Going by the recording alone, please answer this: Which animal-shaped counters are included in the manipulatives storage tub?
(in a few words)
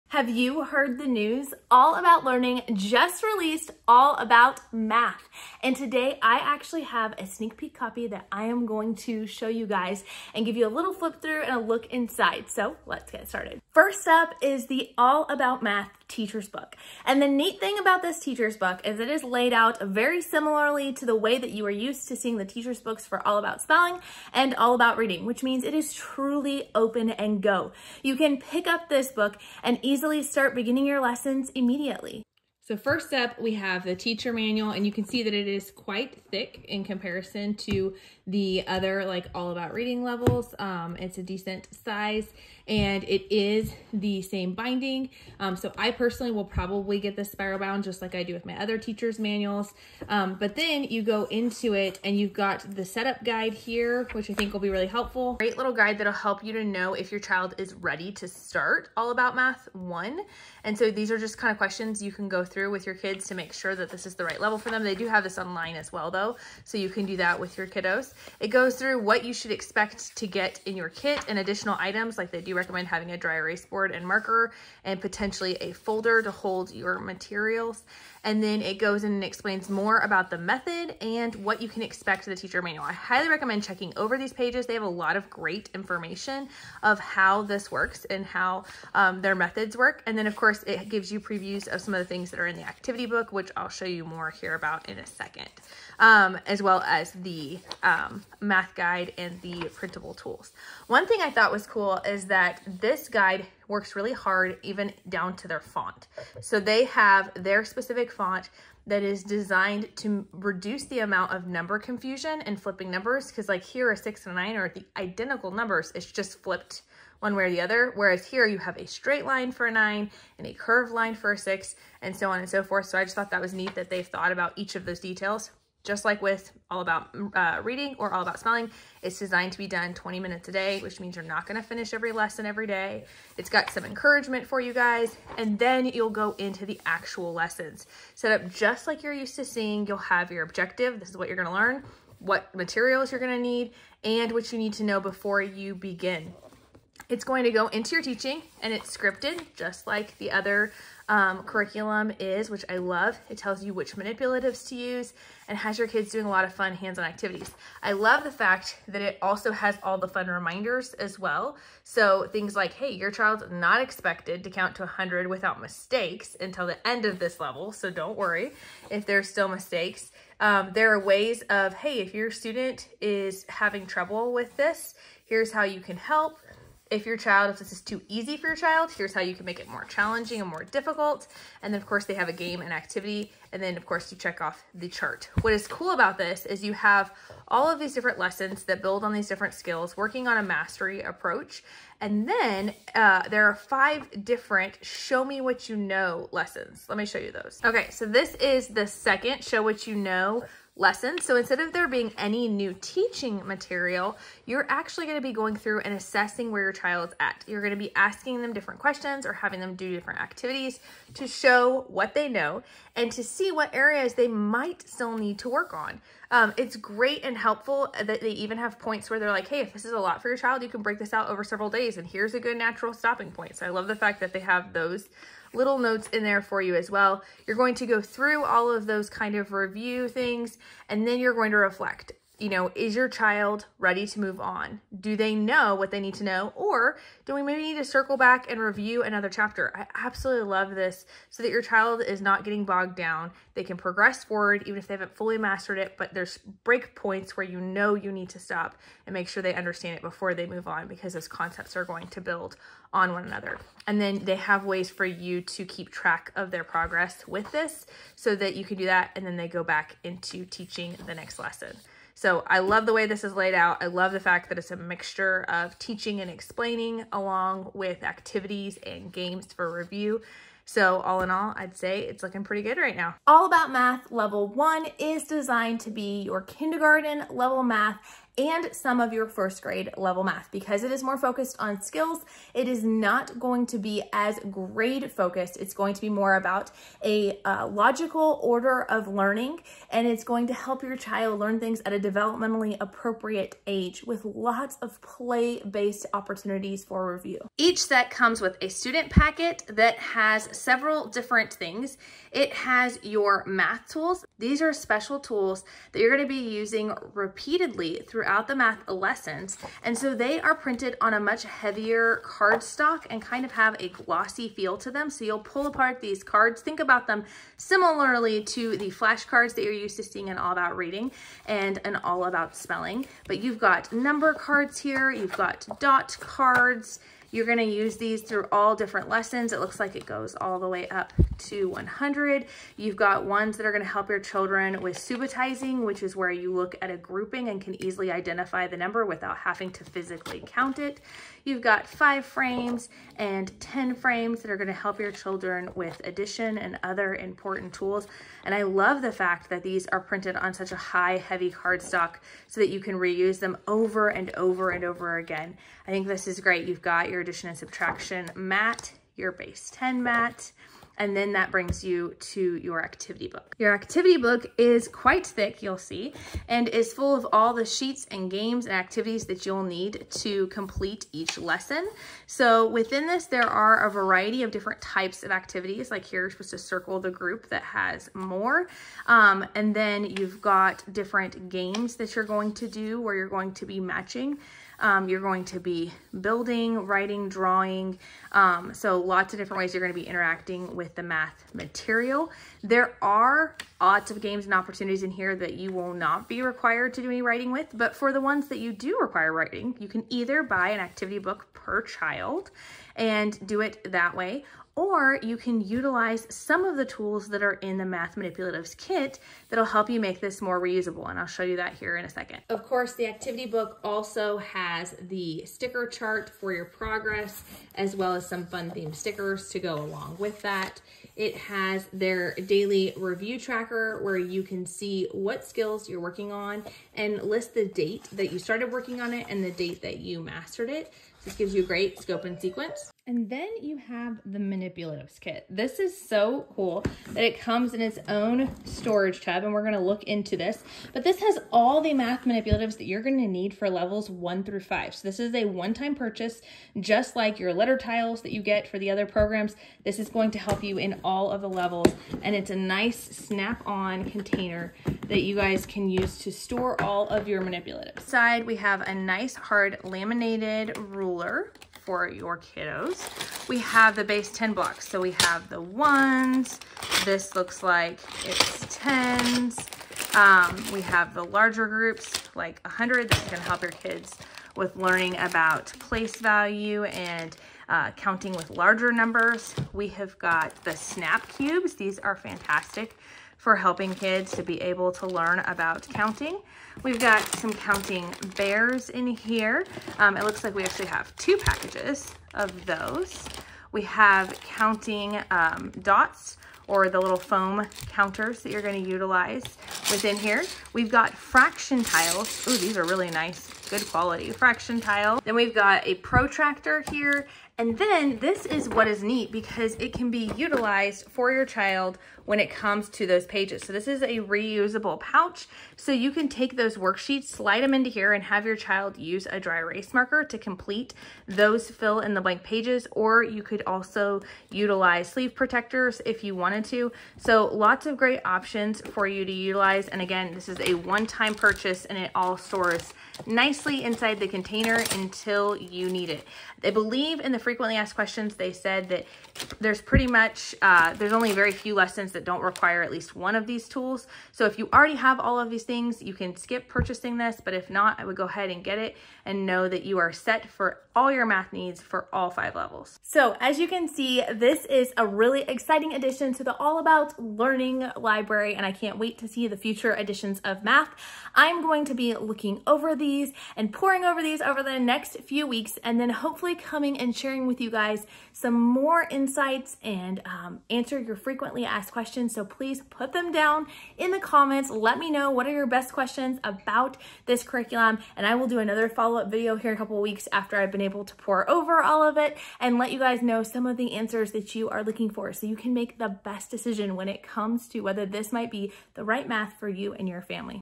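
counting bears.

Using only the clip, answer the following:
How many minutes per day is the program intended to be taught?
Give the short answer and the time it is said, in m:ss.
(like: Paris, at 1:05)
20 minutes, at 2:09.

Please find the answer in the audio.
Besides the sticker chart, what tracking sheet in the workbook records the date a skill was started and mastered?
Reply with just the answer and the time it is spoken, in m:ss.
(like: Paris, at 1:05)
daily review tracker, at 7:02.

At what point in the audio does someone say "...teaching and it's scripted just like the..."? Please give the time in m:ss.
2:28.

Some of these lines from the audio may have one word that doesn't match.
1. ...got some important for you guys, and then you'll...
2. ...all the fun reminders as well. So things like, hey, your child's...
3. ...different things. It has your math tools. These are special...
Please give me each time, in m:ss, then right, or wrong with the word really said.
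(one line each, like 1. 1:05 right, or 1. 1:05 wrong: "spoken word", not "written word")
1. 2:13 wrong: "encouragement", not "important"
2. 2:39 right
3. 5:01 right.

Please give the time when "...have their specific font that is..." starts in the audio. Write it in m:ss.
1:46.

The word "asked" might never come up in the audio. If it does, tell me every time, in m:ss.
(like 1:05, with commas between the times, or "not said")
8:57, 9:31.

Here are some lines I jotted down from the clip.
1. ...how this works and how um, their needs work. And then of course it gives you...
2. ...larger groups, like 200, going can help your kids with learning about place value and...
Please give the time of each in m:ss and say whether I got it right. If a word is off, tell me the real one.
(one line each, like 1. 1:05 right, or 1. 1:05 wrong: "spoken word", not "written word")
1. 1:26 wrong: "methods", not "needs"
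2. 7:51 wrong: "100", not "200".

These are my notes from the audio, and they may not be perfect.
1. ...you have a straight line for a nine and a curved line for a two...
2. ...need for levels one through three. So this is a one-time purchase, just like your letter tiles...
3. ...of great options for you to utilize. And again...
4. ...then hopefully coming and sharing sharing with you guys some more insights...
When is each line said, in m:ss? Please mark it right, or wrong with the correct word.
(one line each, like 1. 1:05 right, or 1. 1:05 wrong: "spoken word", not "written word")
1. 1:58 wrong: "six", not "two"
2. 7:23 wrong: "five", not "three"
3. 8:47 right
4. 9:25 right.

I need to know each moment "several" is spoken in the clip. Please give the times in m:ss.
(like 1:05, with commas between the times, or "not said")
3:41, 5:00.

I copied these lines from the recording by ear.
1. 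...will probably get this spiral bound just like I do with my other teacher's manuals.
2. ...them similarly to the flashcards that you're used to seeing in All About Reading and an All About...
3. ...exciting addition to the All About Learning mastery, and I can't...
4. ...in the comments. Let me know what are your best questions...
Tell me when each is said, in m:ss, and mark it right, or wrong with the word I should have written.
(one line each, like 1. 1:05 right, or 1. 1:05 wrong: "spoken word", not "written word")
1. 0:46 right
2. 5:17 right
3. 9:15 wrong: "library", not "mastery"
4. 9:33 right.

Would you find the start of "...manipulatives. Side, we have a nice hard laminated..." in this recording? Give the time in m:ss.
7:37.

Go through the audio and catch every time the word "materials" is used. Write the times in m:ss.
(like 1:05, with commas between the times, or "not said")
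1:16, 2:22, 3:23, 6:31.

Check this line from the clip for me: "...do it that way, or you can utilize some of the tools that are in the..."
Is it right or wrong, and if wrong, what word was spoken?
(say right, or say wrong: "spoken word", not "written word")
right.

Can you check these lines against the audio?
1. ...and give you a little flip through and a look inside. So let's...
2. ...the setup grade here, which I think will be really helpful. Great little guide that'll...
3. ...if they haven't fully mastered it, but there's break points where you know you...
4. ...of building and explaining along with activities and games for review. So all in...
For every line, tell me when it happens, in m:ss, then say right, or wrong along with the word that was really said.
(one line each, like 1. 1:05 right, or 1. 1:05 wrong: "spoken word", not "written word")
1. 0:10 right
2. 0:52 wrong: "guide", not "grade"
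3. 4:04 right
4. 4:25 wrong: "teaching", not "building".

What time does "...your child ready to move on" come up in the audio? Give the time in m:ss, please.
3:52.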